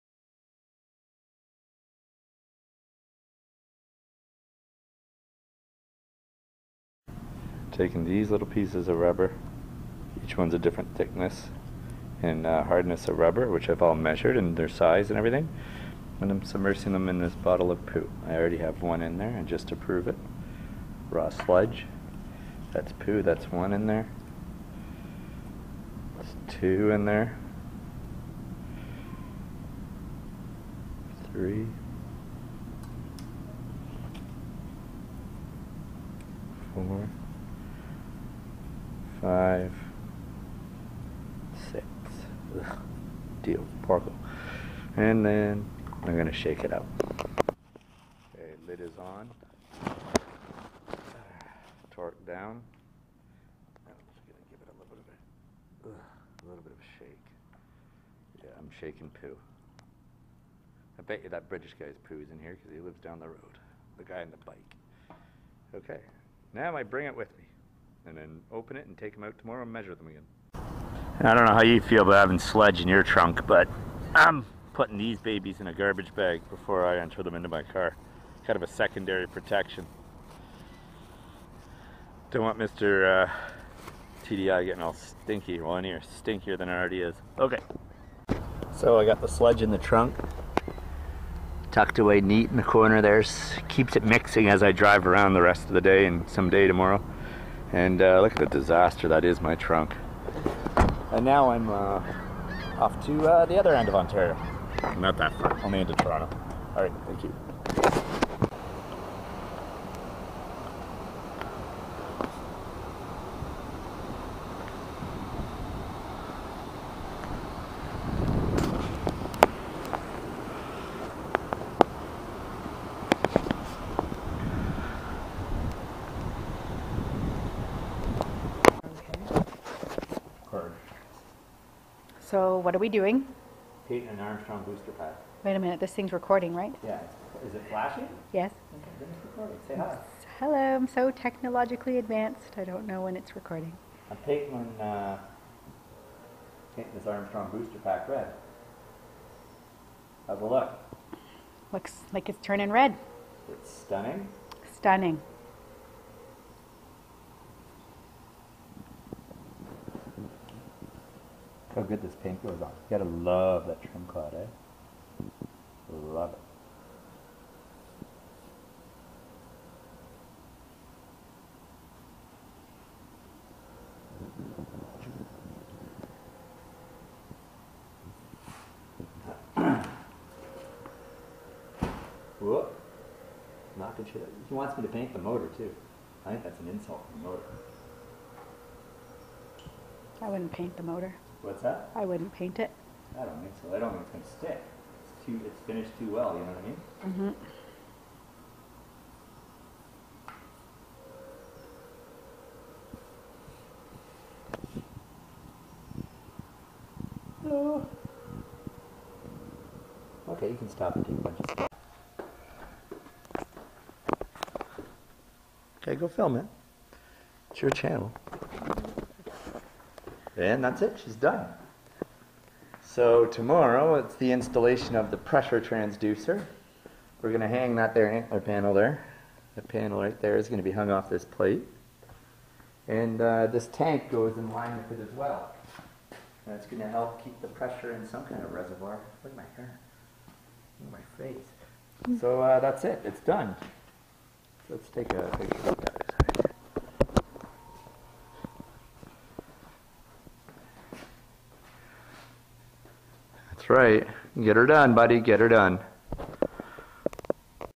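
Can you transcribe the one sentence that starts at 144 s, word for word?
I'm Peyton, uh, painting this Armstrong booster pack red.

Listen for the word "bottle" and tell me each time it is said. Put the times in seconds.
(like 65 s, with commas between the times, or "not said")
17 s.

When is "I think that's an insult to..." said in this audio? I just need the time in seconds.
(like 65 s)
186 s.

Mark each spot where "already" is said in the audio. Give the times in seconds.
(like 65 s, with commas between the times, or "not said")
18 s, 86 s.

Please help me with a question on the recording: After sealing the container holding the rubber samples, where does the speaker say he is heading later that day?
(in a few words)
Toronto.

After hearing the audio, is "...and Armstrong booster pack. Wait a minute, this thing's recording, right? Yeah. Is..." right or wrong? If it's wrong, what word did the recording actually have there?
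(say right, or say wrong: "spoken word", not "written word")
right.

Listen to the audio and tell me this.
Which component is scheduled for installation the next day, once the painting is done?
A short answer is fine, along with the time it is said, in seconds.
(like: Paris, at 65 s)
Pressure transducer, at 225 s.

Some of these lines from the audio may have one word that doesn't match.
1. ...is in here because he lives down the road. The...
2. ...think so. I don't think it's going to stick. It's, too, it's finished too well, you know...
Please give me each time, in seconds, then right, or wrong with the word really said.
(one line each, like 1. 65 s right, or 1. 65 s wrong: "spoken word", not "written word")
1. 62 s right
2. 193 s right.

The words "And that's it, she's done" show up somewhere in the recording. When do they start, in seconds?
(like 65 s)
220 s.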